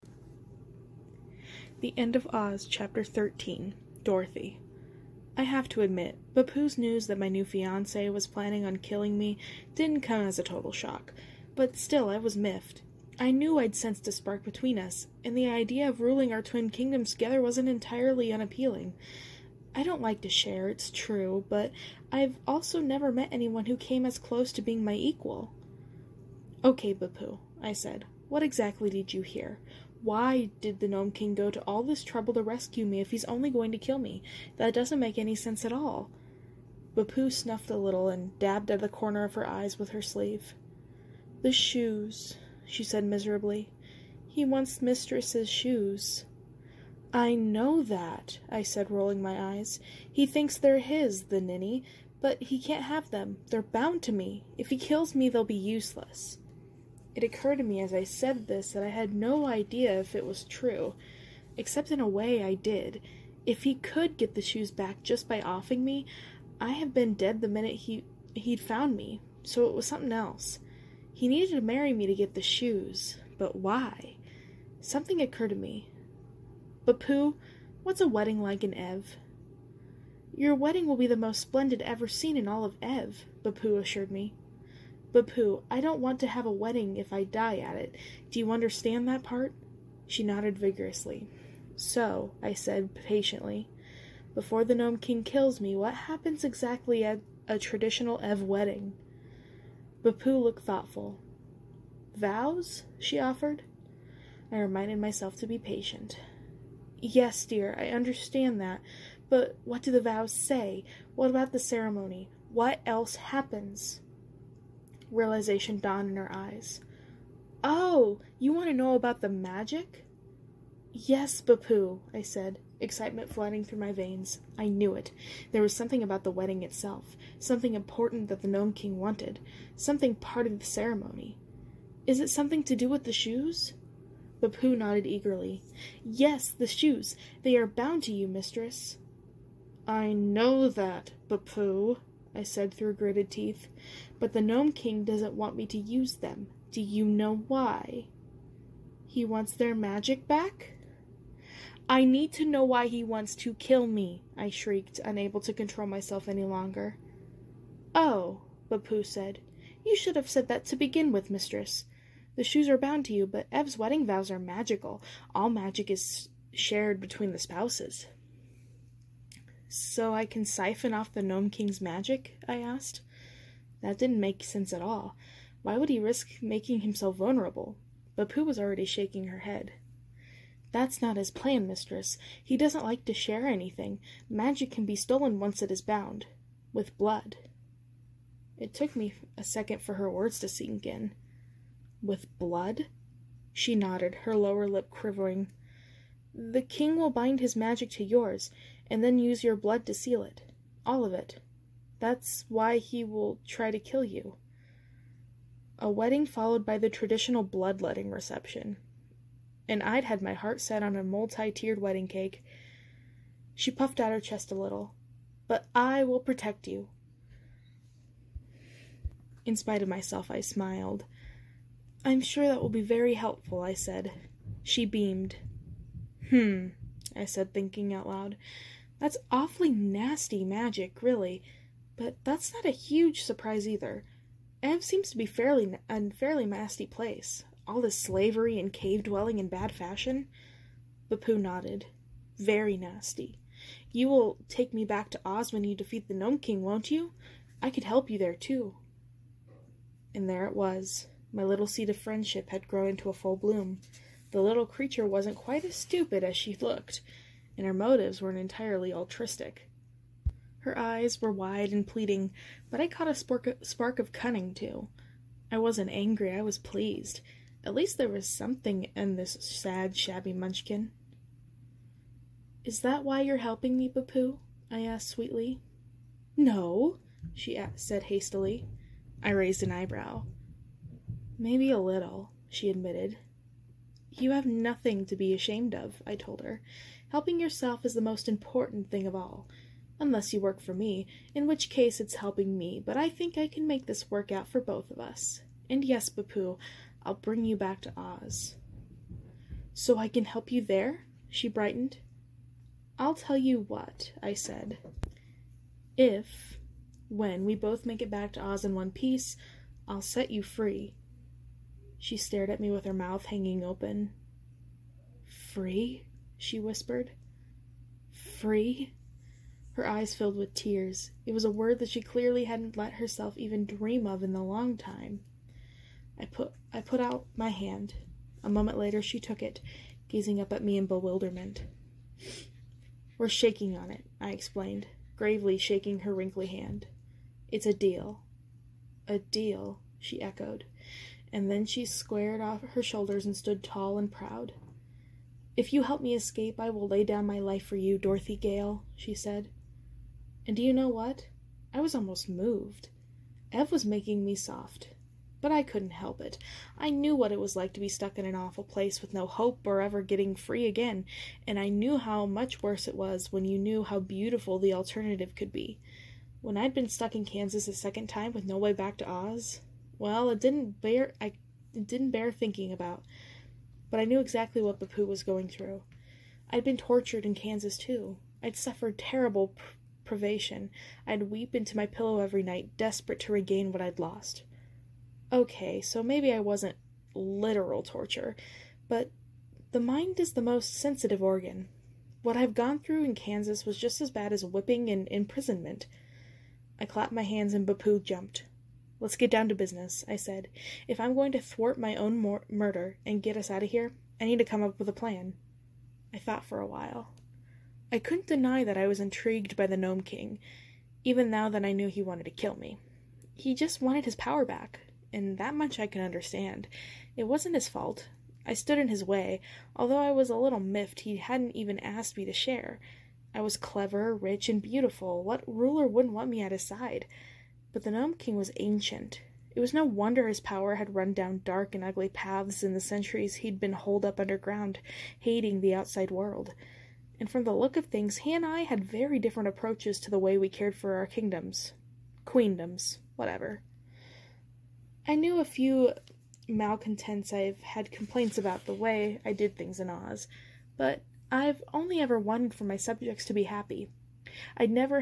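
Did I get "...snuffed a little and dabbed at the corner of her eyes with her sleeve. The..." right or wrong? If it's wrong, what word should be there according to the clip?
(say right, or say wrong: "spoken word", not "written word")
right.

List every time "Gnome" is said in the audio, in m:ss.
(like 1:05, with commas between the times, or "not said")
0:30, 1:34, 2:08, 2:24, 2:51, 4:06, 6:49, 7:07.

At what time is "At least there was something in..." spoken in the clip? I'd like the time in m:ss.
4:27.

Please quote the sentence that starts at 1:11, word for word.
He needed to marry me to get the shoes, but why?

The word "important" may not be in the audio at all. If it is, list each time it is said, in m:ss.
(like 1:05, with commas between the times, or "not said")
2:07, 4:48.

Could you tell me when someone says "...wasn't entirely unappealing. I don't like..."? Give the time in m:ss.
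0:17.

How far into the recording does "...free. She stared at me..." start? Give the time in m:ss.
5:10.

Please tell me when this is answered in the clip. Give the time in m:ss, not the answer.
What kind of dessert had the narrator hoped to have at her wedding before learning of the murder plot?
3:31.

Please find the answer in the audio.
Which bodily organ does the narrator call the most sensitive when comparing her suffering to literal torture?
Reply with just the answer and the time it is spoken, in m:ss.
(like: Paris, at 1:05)
The mind, at 6:29.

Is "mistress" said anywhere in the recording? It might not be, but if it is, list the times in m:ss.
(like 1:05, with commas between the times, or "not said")
0:44, 2:18, 2:41, 3:01.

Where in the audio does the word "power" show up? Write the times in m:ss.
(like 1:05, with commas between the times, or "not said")
6:54, 7:10.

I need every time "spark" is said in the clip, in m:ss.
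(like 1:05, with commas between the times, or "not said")
0:14, 4:23.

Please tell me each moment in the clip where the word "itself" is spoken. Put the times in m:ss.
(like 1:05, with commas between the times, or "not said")
2:06.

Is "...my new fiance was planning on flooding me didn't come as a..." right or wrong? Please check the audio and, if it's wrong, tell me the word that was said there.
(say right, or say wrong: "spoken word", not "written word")
wrong: "killing", not "flooding".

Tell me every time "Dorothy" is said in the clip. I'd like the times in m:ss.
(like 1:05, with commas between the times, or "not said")
0:04, 5:47.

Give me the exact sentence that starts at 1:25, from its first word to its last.
Bapu, I don't want to have a wedding if I die at it.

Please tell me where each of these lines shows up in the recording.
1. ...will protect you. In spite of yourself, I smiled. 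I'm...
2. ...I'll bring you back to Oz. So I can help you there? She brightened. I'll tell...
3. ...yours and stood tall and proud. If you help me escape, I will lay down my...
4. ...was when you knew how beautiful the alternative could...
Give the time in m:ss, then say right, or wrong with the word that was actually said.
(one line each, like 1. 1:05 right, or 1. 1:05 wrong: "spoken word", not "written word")
1. 3:36 wrong: "myself", not "yourself"
2. 4:57 right
3. 5:42 wrong: "shoulders", not "yours"
4. 6:02 right.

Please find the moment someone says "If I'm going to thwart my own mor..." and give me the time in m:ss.
6:40.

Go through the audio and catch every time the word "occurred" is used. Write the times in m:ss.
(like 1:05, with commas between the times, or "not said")
0:57, 1:15.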